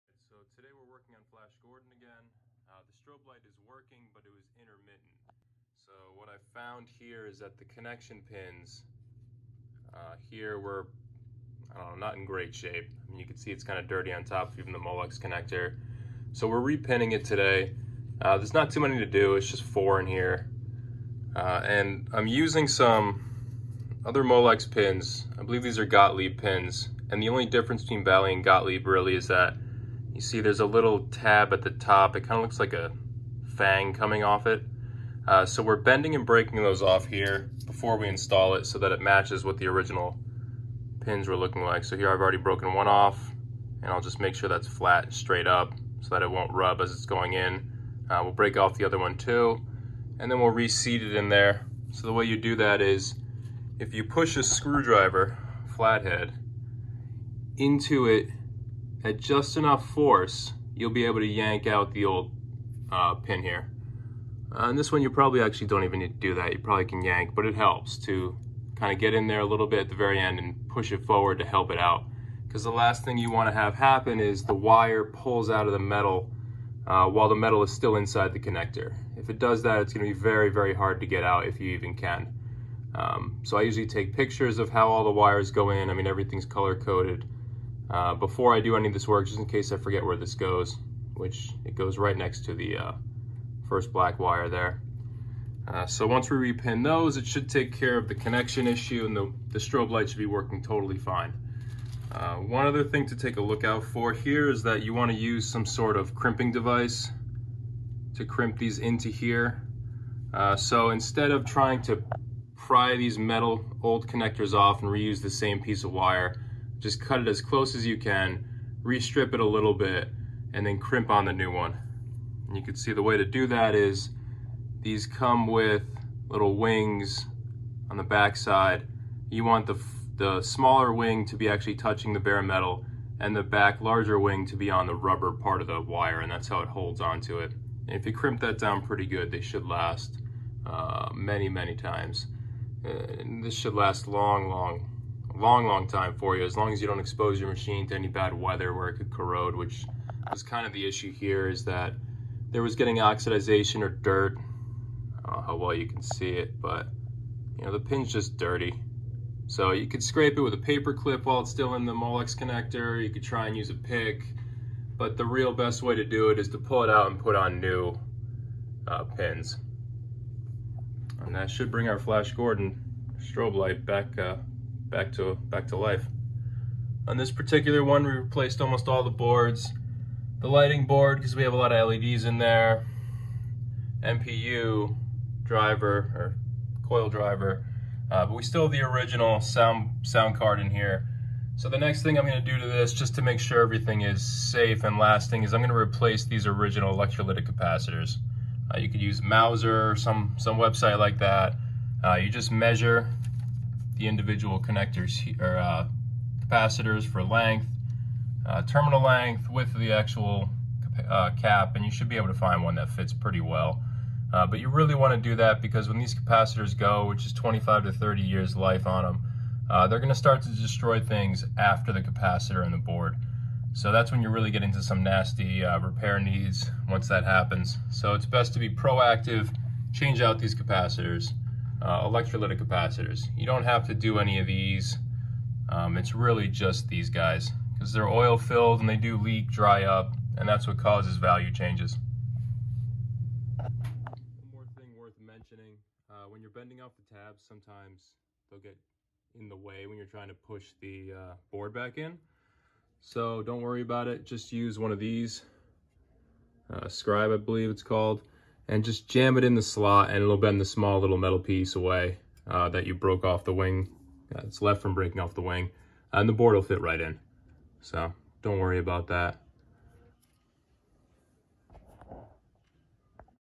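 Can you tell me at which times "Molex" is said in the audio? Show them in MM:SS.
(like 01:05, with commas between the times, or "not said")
00:14, 00:24, 02:41.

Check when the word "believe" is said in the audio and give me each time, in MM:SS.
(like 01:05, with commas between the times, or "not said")
00:25, 04:17.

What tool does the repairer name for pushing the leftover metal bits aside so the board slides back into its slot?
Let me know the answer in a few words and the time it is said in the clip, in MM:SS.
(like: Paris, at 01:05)
Scribe, at 04:16.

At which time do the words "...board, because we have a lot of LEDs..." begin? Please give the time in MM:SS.
03:00.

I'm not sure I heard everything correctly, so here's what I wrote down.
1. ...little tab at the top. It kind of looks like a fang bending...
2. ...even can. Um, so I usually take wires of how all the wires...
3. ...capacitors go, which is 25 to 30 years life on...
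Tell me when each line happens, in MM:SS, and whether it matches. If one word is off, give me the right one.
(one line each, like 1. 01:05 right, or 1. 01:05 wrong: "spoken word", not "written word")
1. 00:30 wrong: "coming", not "bending"
2. 01:21 wrong: "pictures", not "wires"
3. 03:36 right.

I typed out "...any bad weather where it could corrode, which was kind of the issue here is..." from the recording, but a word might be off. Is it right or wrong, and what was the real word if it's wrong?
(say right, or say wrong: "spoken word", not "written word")
right.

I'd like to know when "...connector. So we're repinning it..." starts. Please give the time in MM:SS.
00:15.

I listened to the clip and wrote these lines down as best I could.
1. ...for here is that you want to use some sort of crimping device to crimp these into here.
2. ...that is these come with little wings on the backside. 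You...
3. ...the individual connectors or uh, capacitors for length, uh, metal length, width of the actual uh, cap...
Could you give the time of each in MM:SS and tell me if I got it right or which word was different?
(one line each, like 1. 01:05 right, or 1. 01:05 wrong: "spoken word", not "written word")
1. 01:43 right
2. 02:03 right
3. 03:24 wrong: "terminal", not "metal".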